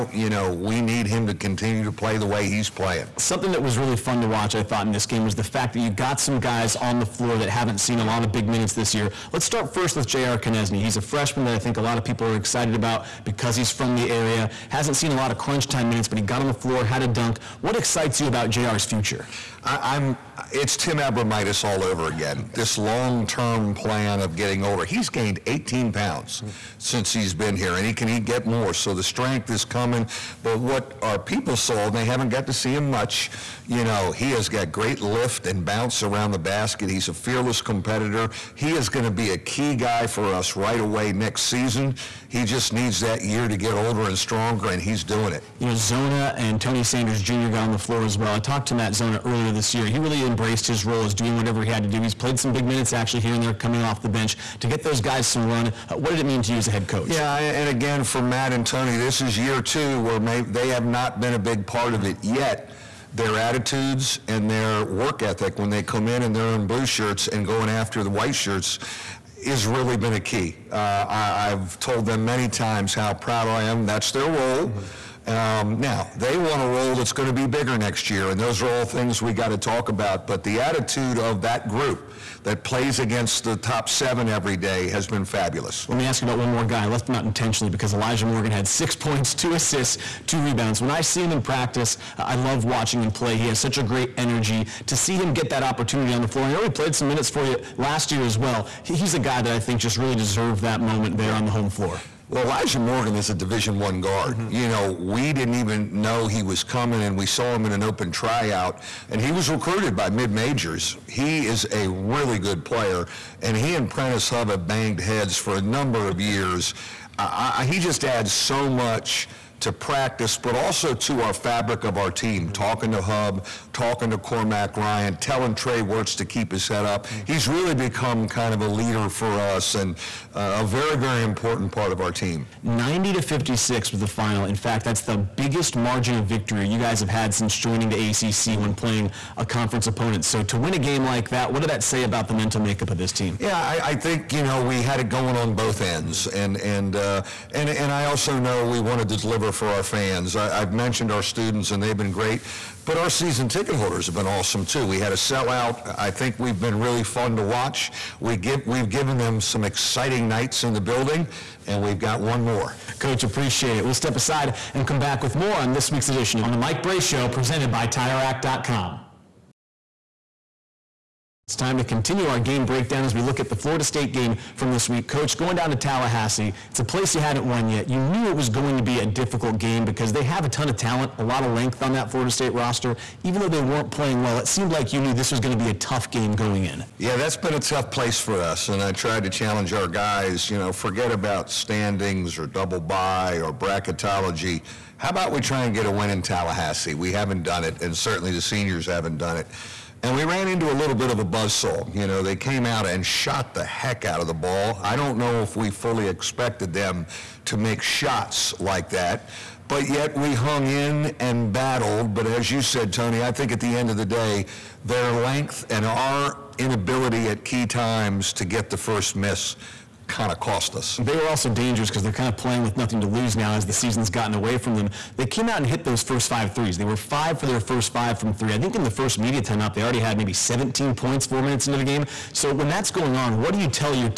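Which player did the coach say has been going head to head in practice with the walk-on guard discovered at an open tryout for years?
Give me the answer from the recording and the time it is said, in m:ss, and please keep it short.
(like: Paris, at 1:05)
Prentiss Hubb, at 1:53.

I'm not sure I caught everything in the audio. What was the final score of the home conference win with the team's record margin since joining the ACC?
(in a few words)
90 to 56.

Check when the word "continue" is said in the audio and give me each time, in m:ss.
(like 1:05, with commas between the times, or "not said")
0:01, 2:51.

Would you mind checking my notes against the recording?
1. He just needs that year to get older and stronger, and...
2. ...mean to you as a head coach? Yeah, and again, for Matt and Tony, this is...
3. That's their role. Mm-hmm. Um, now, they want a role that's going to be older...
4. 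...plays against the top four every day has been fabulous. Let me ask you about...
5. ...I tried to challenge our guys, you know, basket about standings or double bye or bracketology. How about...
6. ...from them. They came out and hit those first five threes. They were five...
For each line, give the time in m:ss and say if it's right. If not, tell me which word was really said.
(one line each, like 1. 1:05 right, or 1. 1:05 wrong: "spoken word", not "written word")
1. 0:42 right
2. 0:56 right
3. 1:13 wrong: "bigger", not "older"
4. 1:22 wrong: "seven", not "four"
5. 3:08 wrong: "forget", not "basket"
6. 3:44 right.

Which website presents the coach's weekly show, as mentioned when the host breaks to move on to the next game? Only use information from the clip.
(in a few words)
TireRack.com.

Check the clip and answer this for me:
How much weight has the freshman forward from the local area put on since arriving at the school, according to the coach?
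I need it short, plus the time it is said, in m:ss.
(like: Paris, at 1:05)
18 pounds, at 0:25.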